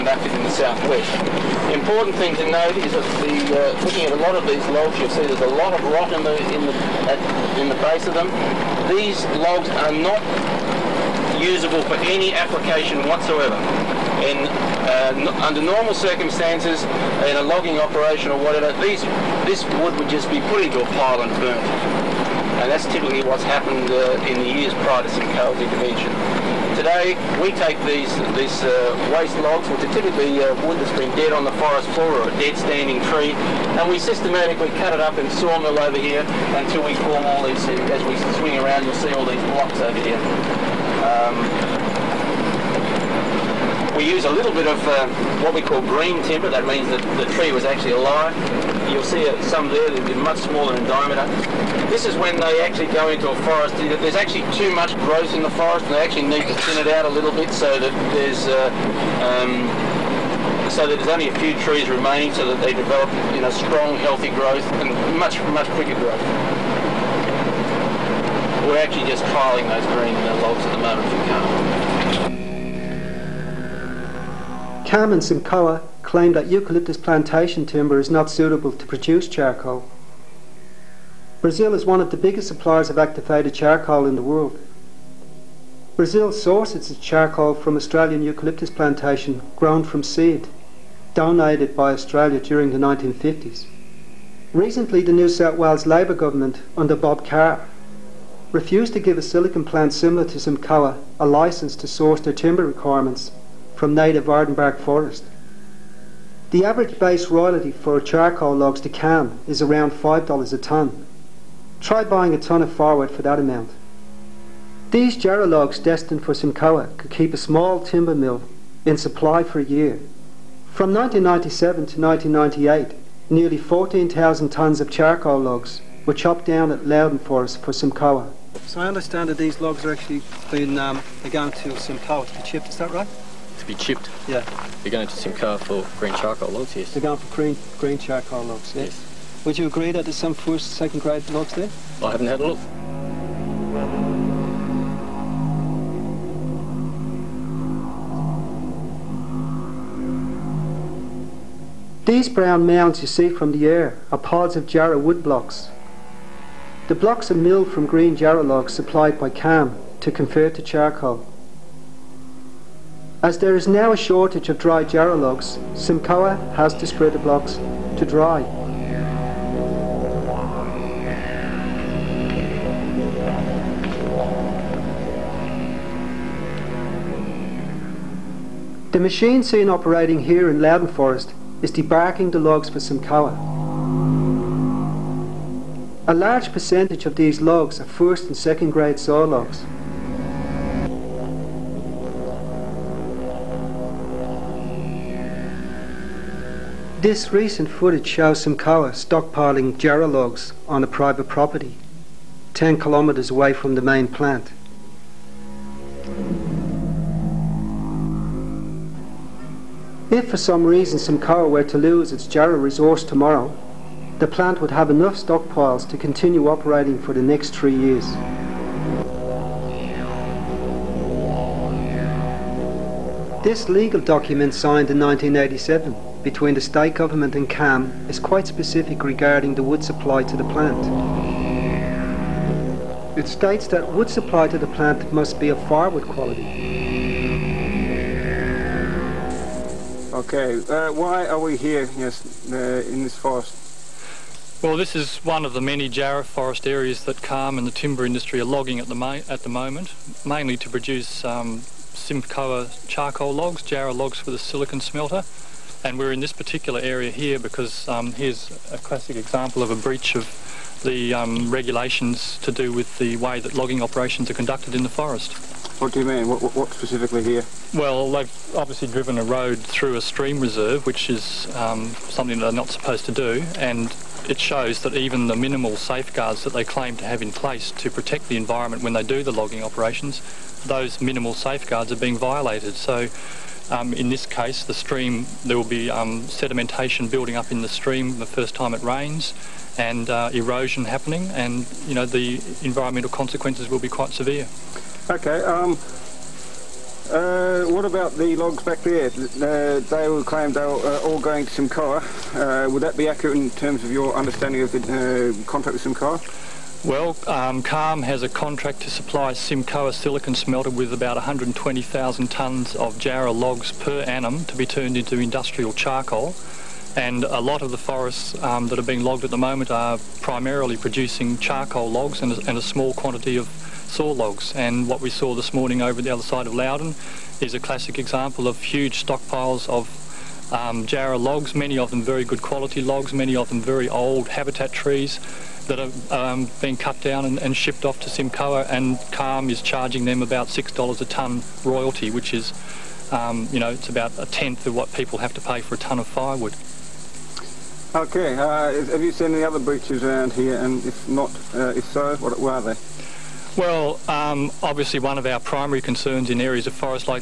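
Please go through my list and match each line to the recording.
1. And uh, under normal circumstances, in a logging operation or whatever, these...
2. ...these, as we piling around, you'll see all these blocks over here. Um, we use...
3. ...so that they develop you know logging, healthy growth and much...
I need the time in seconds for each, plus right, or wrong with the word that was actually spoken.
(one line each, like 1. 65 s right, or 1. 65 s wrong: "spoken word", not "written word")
1. 14 s right
2. 37 s wrong: "swing", not "piling"
3. 62 s wrong: "strong", not "logging".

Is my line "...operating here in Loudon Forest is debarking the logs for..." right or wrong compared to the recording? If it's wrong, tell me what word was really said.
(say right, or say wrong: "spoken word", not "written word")
right.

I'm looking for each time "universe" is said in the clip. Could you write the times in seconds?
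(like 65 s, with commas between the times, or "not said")
not said.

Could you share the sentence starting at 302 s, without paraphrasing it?
Uh, would that be accurate in terms of your understanding of the uh, contract with Simcoa?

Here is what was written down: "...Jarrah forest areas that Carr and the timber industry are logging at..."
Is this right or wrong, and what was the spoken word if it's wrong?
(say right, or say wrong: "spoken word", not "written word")
wrong: "CALM", not "Carr".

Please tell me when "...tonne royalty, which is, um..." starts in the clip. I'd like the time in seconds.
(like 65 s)
341 s.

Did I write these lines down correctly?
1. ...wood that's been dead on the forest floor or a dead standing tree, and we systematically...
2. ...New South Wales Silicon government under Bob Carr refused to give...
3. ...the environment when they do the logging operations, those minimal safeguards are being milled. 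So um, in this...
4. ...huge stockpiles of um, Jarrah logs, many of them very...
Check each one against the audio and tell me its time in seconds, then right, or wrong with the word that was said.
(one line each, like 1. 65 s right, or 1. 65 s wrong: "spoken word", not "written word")
1. 30 s right
2. 95 s wrong: "Labor", not "Silicon"
3. 278 s wrong: "violated", not "milled"
4. 328 s right.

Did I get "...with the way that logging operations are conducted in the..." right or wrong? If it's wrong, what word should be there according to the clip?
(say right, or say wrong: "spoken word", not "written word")
right.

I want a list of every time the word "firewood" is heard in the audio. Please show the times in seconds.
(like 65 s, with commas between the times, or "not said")
235 s, 346 s.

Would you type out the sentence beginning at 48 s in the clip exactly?
You'll see some there that are much smaller in diameter.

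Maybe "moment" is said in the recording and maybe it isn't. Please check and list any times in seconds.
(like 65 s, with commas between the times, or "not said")
70 s, 249 s, 319 s.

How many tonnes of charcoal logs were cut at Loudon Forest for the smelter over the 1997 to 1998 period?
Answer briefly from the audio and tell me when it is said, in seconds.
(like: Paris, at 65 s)
14,000 tonnes, at 123 s.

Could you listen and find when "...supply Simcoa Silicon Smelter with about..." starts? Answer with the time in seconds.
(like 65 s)
308 s.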